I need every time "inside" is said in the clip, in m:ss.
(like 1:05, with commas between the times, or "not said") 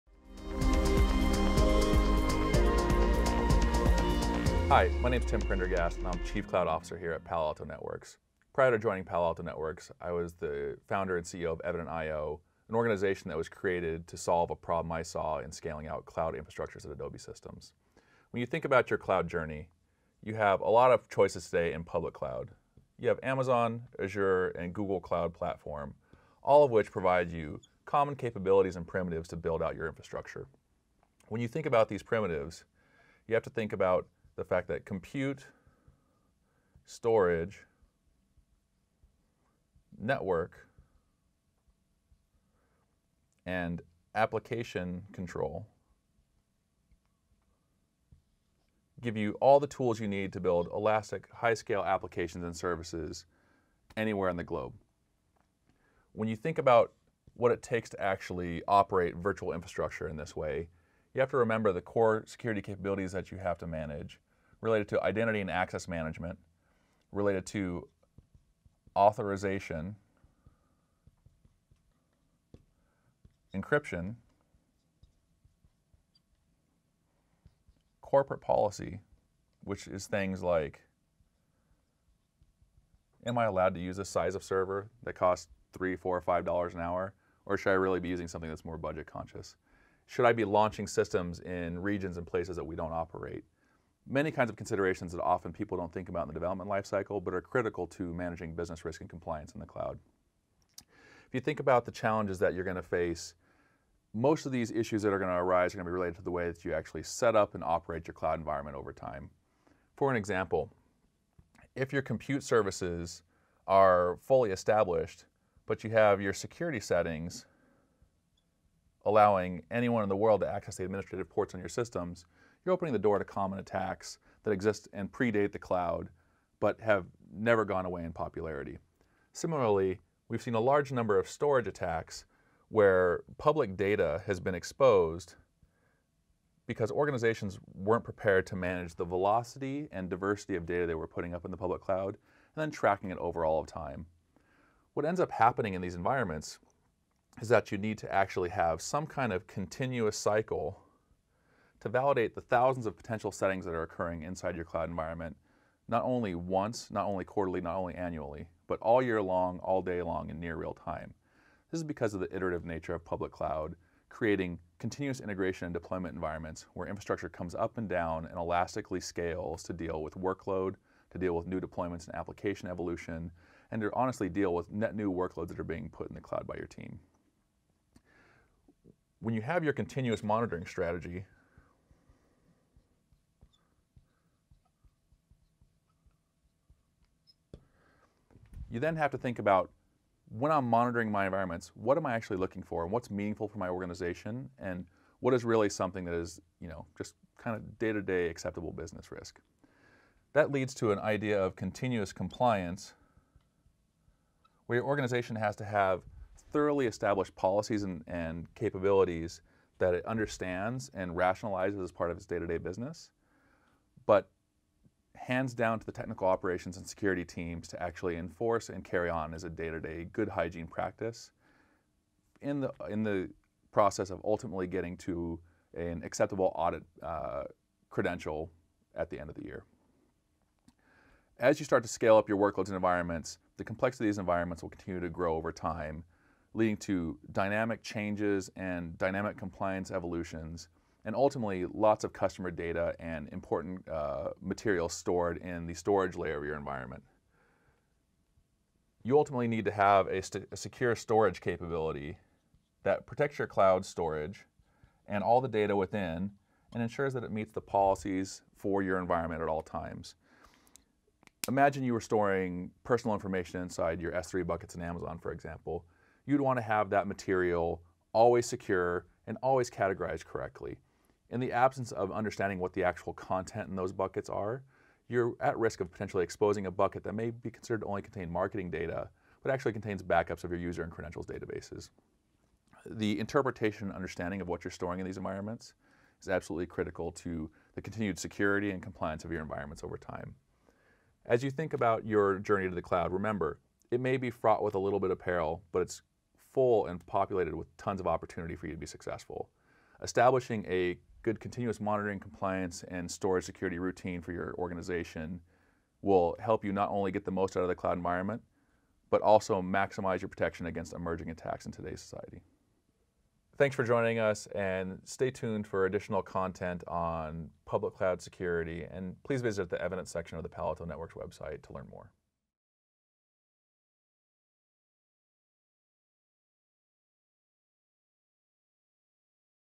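2:34, 4:23.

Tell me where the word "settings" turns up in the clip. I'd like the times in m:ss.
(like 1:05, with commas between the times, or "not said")
1:56, 2:33.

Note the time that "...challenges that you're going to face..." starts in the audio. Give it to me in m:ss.
1:41.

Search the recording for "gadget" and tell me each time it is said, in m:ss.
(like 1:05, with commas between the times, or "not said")
not said.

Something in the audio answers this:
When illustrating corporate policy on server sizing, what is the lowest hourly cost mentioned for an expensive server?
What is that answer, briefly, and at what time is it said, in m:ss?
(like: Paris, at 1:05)
$3 an hour, at 1:25.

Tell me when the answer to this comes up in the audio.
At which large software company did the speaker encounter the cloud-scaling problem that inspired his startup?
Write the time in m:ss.
0:16.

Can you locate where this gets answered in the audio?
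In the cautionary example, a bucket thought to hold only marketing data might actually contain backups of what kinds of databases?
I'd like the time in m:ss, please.
4:40.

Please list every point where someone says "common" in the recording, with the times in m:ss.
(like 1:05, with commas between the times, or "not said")
0:27, 2:03.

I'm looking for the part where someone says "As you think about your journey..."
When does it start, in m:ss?
4:51.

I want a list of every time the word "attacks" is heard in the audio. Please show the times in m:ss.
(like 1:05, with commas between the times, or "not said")
2:03, 2:11, 5:11.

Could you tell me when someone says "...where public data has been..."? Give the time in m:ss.
2:12.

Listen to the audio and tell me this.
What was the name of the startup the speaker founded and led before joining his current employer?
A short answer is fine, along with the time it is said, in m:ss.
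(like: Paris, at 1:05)
Evident.io, at 0:11.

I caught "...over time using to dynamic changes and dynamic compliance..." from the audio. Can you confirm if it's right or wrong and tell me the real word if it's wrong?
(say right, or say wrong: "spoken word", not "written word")
wrong: "leading", not "using".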